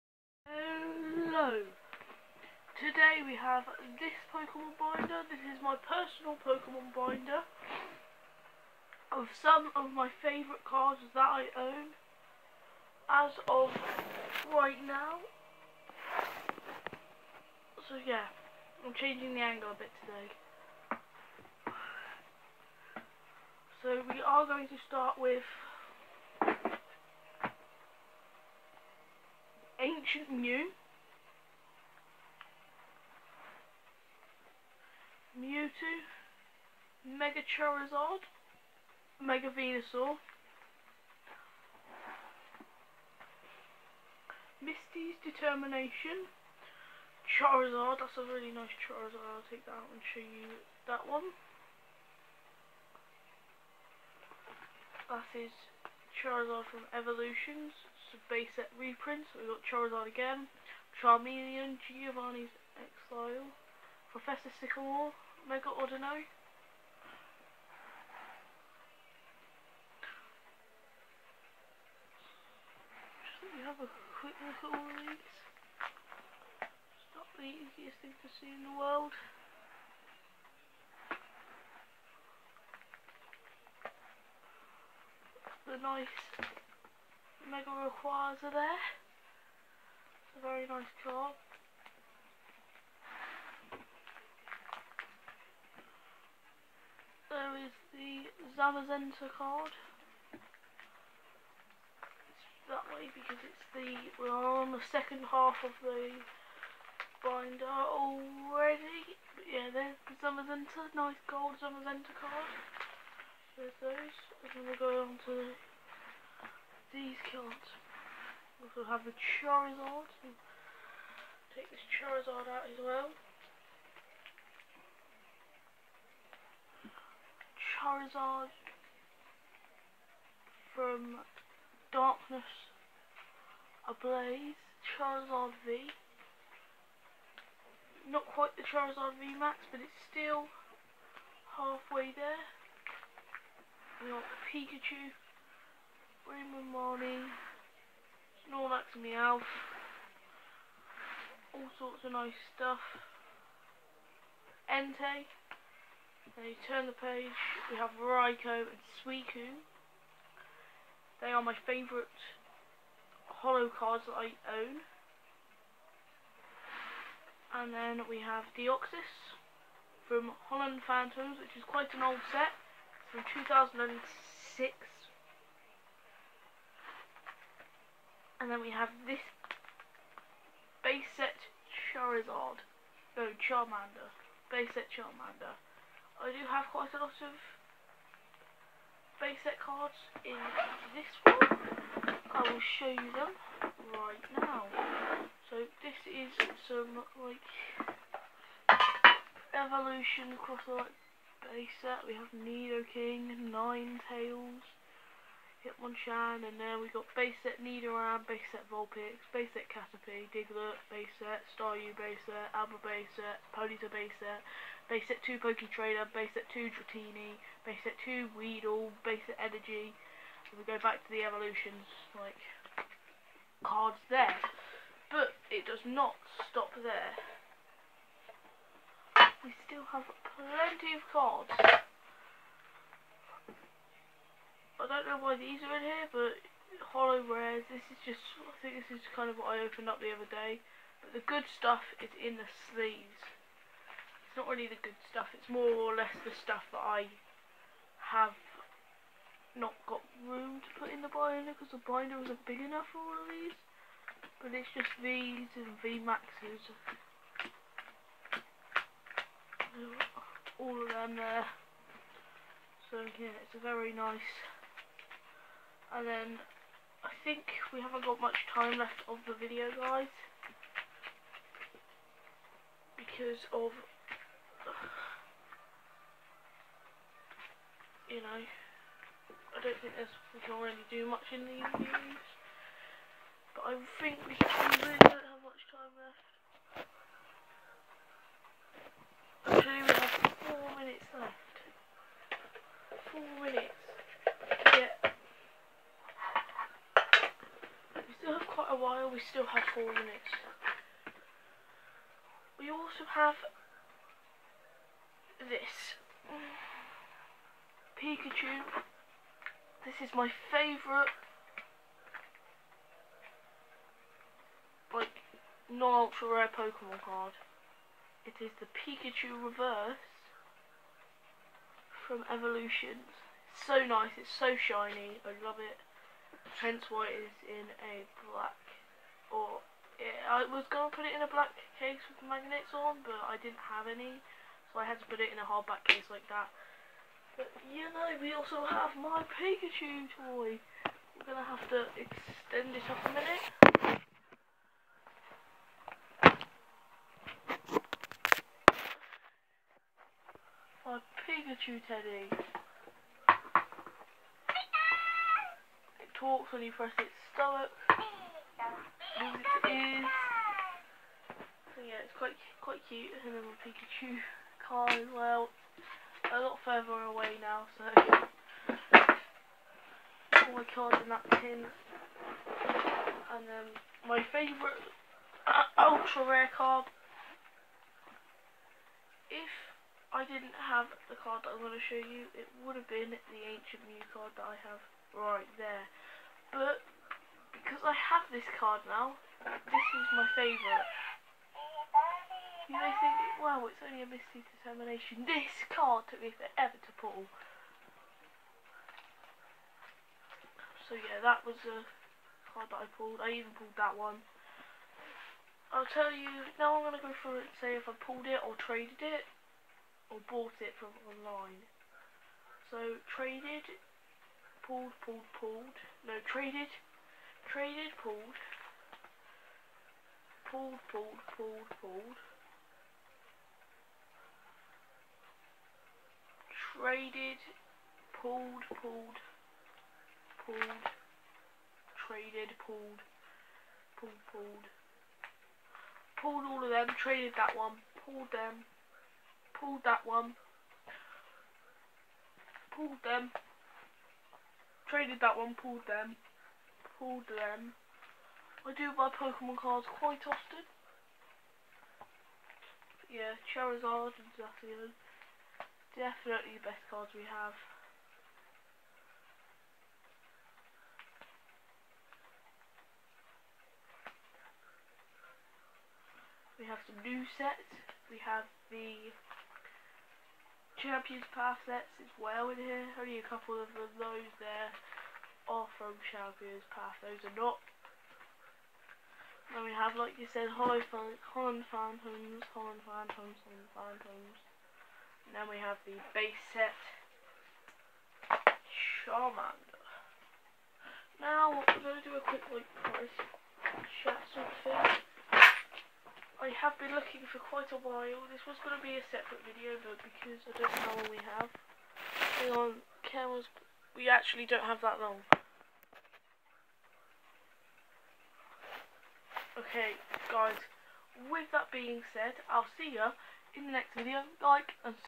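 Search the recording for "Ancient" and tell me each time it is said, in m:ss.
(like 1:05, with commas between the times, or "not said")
0:29, 6:23.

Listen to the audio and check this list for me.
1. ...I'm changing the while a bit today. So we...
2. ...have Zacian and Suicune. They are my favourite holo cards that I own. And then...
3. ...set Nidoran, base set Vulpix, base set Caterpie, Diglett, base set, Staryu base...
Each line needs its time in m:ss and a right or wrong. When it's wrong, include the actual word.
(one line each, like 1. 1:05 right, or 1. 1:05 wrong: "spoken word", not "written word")
1. 0:18 wrong: "angle", not "while"
2. 2:37 wrong: "Raikou", not "Zacian"
3. 3:27 right.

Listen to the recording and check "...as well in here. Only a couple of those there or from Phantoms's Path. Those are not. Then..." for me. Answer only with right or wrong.
wrong.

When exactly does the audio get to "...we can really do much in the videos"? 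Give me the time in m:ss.
4:40.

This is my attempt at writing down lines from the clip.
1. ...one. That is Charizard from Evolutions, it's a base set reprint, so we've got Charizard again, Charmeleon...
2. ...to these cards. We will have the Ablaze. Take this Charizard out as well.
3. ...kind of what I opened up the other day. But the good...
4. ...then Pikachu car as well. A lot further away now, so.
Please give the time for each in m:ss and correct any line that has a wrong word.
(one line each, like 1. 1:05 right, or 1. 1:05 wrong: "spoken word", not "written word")
1. 0:51 right
2. 1:55 wrong: "Charizard", not "Ablaze"
3. 3:59 right
4. 6:03 right.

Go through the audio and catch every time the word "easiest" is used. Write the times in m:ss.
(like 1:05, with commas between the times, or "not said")
1:17.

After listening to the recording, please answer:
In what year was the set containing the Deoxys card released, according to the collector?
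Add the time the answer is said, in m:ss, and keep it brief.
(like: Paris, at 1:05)
2006, at 2:53.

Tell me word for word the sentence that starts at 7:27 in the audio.
Um, I do buy Pokemon cards quite often.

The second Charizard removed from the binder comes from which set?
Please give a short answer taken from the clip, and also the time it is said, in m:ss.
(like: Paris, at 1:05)
Darkness Ablaze, at 2:11.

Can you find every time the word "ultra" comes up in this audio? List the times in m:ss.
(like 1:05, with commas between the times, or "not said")
5:15, 6:15.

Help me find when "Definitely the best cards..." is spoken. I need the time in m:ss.
7:35.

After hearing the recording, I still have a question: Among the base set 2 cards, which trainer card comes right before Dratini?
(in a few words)
Poketrader.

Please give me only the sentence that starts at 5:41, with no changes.
We're going to have to extend it up a minute.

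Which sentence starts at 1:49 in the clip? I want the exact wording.
But yeah, there's the Zamazenta, nice gold Zamazenta card.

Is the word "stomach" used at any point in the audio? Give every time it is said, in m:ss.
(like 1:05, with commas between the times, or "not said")
5:57.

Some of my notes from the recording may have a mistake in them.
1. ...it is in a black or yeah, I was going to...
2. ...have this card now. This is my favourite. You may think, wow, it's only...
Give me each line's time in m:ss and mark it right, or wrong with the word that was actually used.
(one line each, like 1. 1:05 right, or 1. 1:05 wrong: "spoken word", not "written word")
1. 5:27 right
2. 6:27 right.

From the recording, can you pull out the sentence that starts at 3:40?
And we go back to the evolutions, like, cards there.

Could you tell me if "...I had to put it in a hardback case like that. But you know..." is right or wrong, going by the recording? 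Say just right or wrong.
right.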